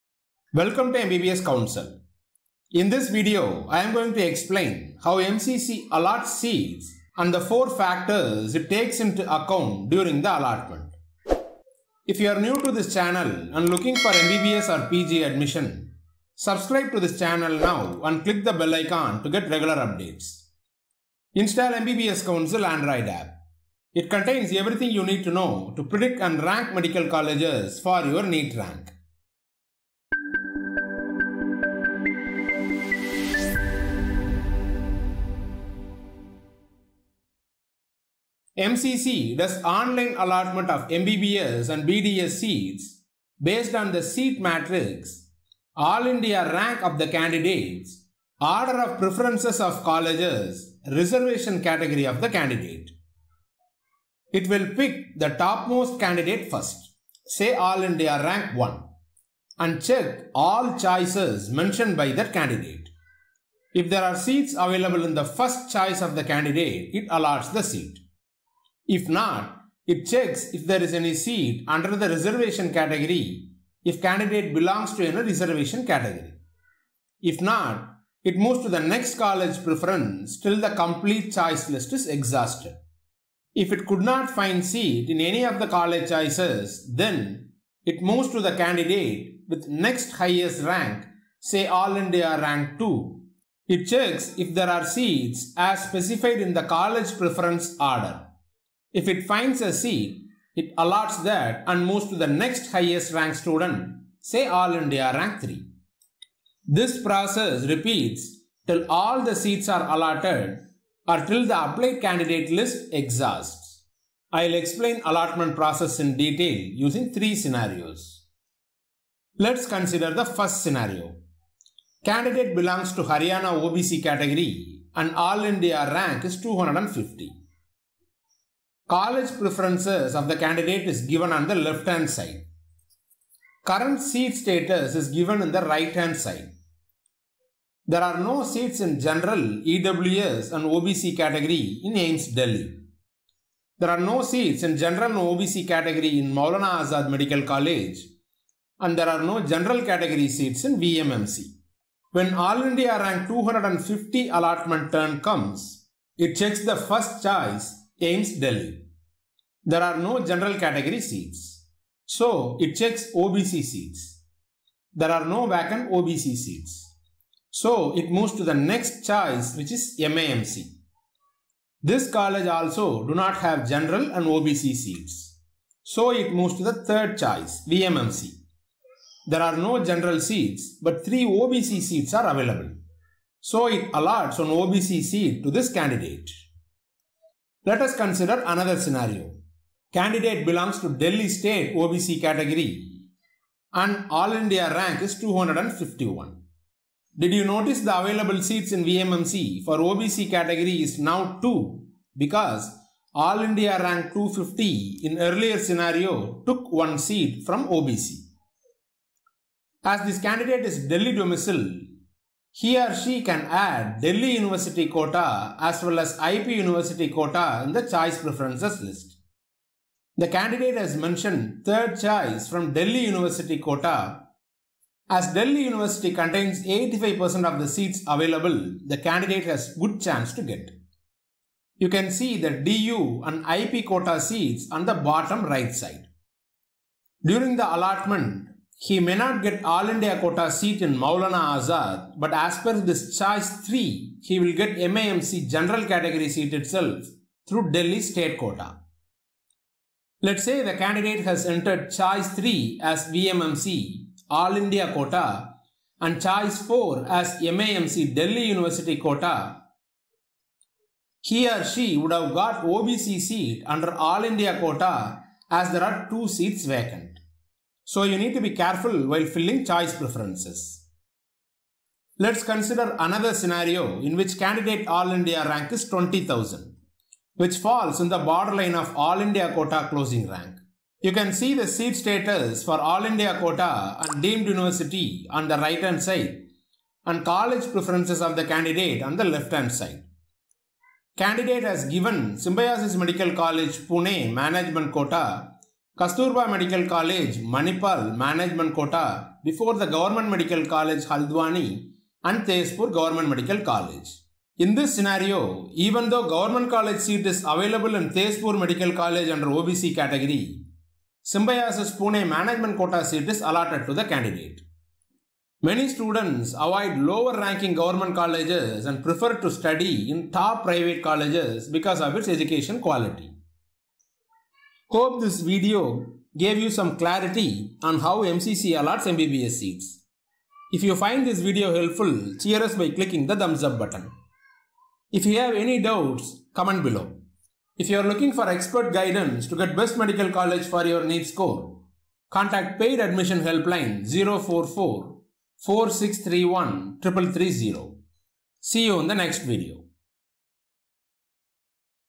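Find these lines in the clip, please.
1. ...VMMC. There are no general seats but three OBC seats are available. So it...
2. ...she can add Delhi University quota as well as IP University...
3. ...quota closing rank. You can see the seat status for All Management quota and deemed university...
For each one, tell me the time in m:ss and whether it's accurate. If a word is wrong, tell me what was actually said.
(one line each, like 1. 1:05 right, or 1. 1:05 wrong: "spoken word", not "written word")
1. 2:57 right
2. 3:32 right
3. 4:39 wrong: "India", not "Management".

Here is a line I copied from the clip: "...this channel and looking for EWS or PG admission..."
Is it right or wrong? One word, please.
wrong.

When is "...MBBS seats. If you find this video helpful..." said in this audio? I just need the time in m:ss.
5:29.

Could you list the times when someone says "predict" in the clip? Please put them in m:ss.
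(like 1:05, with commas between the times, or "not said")
0:25.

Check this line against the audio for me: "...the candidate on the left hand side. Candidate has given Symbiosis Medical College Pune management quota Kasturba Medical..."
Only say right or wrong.
right.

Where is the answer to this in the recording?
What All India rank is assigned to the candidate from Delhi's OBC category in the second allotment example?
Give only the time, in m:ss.
3:14.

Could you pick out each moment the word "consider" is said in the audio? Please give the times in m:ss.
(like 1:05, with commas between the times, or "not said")
1:59, 3:07, 4:32.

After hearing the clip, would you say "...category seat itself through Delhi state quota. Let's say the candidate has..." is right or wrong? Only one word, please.
right.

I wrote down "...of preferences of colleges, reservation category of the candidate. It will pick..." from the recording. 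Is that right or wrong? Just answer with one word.
right.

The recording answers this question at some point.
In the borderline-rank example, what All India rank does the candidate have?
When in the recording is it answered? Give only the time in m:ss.
4:35.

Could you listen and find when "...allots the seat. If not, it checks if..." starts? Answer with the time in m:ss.
1:07.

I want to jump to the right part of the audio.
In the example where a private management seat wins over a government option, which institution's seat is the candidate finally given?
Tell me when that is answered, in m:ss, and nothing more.
5:11.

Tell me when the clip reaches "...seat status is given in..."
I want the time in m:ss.
2:14.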